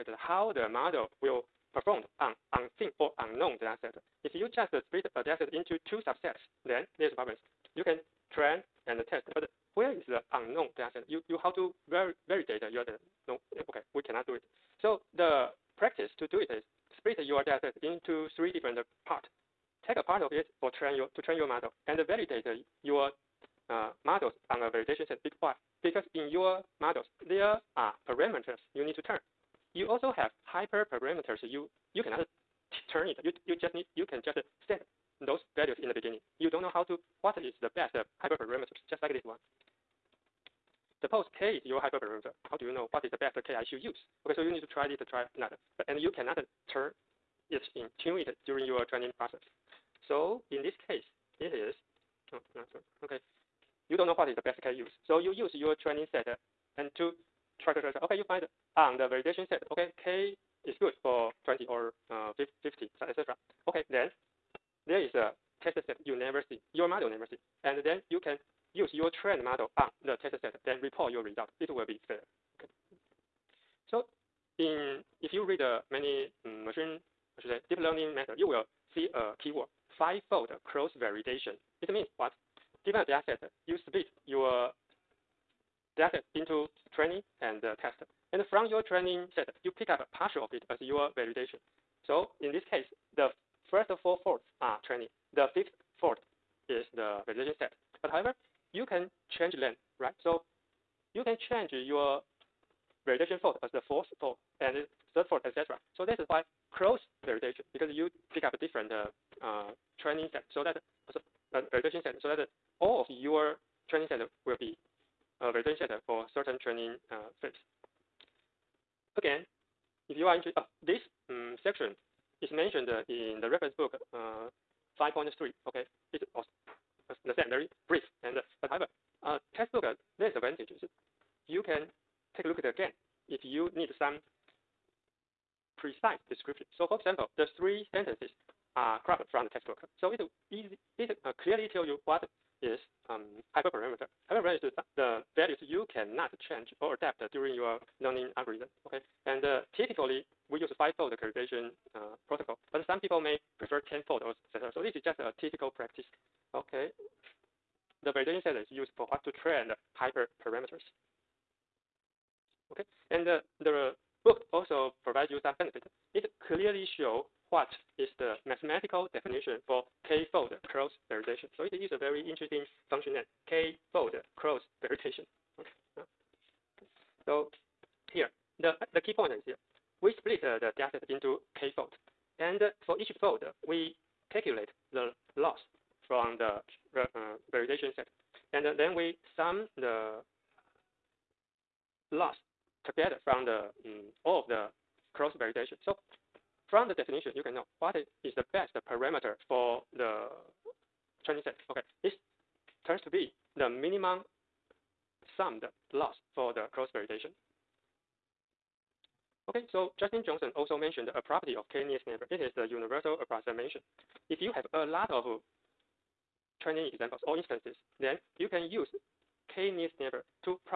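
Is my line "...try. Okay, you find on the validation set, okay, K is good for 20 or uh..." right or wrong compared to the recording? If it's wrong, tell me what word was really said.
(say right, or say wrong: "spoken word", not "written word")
right.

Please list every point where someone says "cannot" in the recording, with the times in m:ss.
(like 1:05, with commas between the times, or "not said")
0:14, 0:32, 0:46, 2:25.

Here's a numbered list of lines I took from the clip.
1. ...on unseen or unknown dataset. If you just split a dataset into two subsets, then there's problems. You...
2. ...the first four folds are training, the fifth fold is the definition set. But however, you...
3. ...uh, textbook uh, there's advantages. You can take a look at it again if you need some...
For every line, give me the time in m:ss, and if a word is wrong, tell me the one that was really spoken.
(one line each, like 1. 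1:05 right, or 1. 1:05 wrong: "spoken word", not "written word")
1. 0:02 right
2. 1:33 wrong: "validation", not "definition"
3. 2:09 right.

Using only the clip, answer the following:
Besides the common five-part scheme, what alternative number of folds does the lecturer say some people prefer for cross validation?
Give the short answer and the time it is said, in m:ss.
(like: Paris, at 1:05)
ten-fold, at 2:33.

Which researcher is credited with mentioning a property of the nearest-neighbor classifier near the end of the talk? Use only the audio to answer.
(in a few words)
Justin Johnson.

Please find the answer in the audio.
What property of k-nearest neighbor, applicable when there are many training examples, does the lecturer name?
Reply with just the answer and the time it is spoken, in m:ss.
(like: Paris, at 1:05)
universal approximation, at 3:32.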